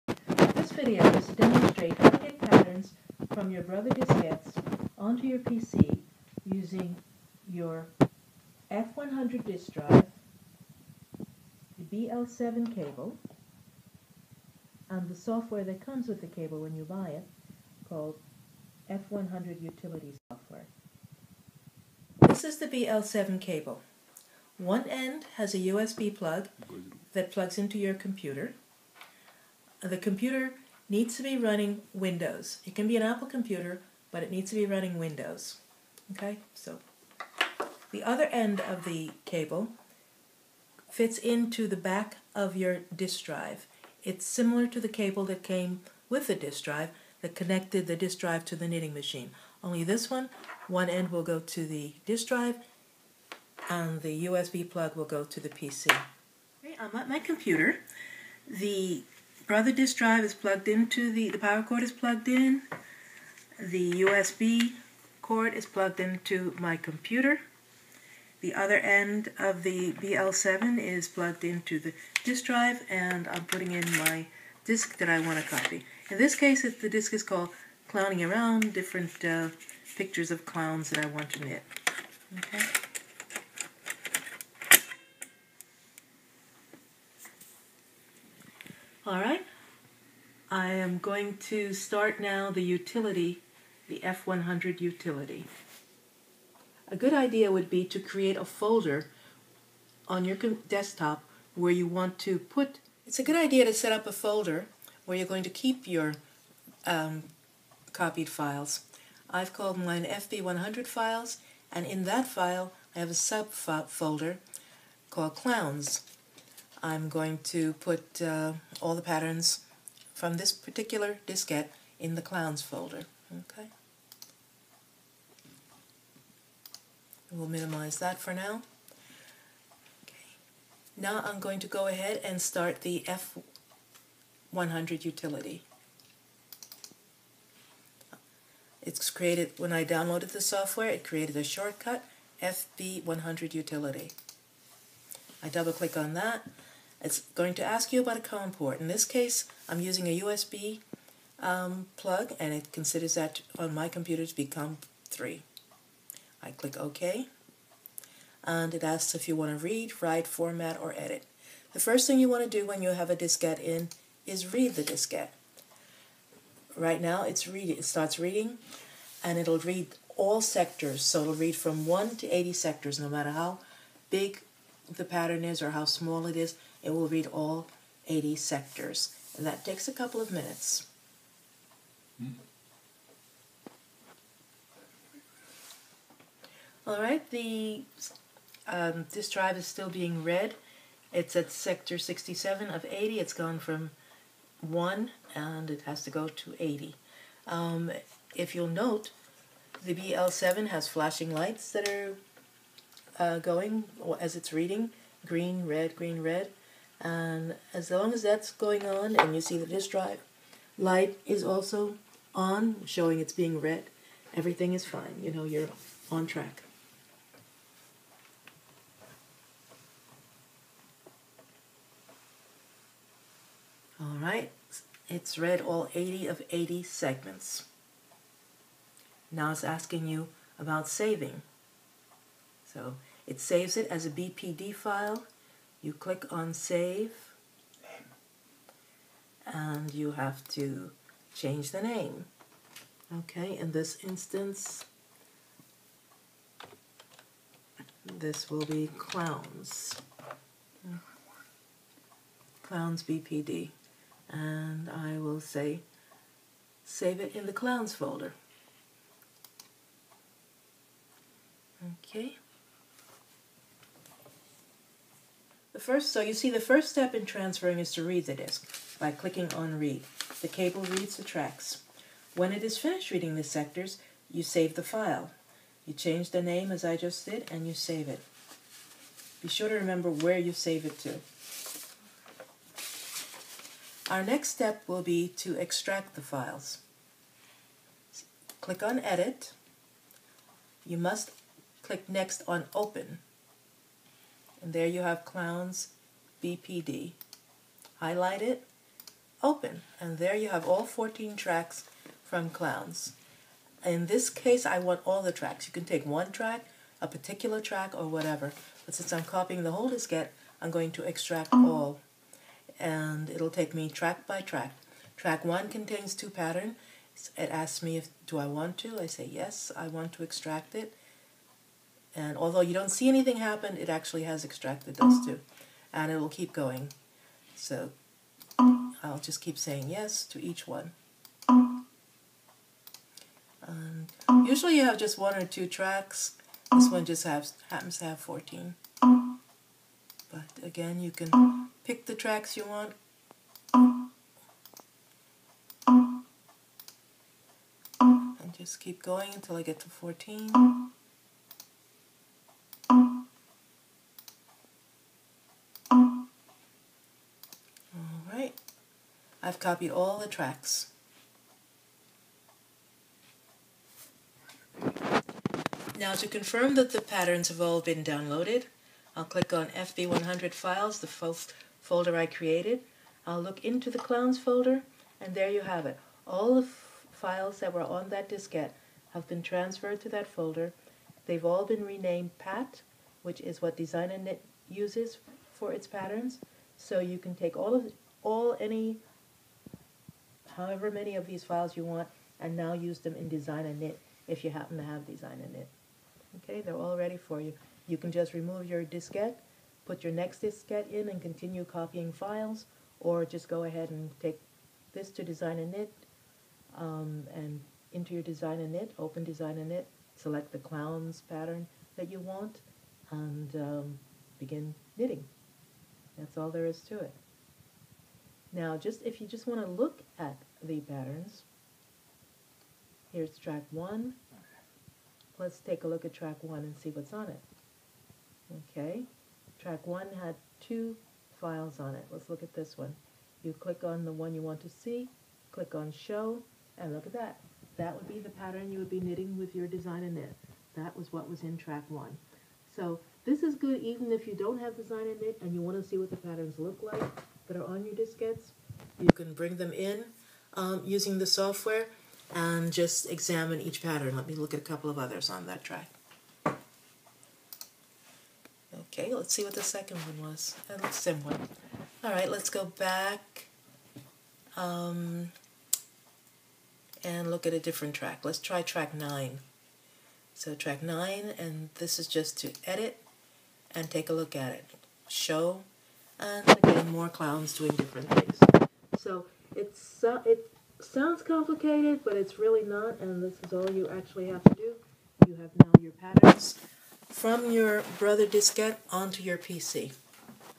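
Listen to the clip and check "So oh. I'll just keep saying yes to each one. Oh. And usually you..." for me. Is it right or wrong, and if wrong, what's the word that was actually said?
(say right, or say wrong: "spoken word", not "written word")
right.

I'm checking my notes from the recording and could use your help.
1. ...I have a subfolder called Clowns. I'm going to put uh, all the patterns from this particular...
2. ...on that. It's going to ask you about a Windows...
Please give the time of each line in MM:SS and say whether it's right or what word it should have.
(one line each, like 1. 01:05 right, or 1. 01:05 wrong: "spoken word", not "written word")
1. 01:52 right
2. 02:25 wrong: "COM", not "Windows".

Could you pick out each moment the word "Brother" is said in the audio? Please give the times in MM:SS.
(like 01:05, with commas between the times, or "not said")
00:03, 08:07.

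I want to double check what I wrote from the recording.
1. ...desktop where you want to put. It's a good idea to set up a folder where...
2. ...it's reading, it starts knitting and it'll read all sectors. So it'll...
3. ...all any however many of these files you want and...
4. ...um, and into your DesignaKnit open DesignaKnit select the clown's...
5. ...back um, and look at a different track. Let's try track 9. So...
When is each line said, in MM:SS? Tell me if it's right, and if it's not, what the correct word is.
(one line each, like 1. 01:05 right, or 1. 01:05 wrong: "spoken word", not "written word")
1. 01:40 right
2. 02:47 wrong: "reading", not "knitting"
3. 06:28 right
4. 06:46 right
5. 07:42 right.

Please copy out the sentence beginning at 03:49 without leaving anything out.
Now it's asking you about saving.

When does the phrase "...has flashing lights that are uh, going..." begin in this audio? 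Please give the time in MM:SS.
03:20.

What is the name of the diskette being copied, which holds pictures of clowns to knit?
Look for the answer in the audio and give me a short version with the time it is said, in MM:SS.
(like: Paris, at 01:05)
Clowning Around, at 01:17.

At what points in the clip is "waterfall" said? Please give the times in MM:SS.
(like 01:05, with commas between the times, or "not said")
not said.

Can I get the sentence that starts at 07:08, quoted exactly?
Okay, track one had two files on it.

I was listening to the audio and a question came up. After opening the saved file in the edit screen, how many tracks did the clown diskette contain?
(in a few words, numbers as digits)
14.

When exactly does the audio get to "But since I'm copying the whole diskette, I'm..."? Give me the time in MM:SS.
05:08.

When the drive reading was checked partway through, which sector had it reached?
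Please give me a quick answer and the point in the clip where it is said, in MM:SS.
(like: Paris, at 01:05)
67, at 03:11.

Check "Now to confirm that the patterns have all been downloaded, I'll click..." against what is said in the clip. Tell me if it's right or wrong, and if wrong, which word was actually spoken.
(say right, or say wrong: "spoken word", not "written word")
right.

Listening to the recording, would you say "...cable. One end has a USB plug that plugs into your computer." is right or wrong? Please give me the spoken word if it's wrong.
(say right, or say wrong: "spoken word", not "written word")
right.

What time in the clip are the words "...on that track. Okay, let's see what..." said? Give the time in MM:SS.
07:35.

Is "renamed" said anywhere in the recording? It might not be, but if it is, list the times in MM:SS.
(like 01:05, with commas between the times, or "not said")
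06:21.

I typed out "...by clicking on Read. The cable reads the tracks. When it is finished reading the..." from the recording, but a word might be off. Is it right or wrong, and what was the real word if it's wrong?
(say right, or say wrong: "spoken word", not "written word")
right.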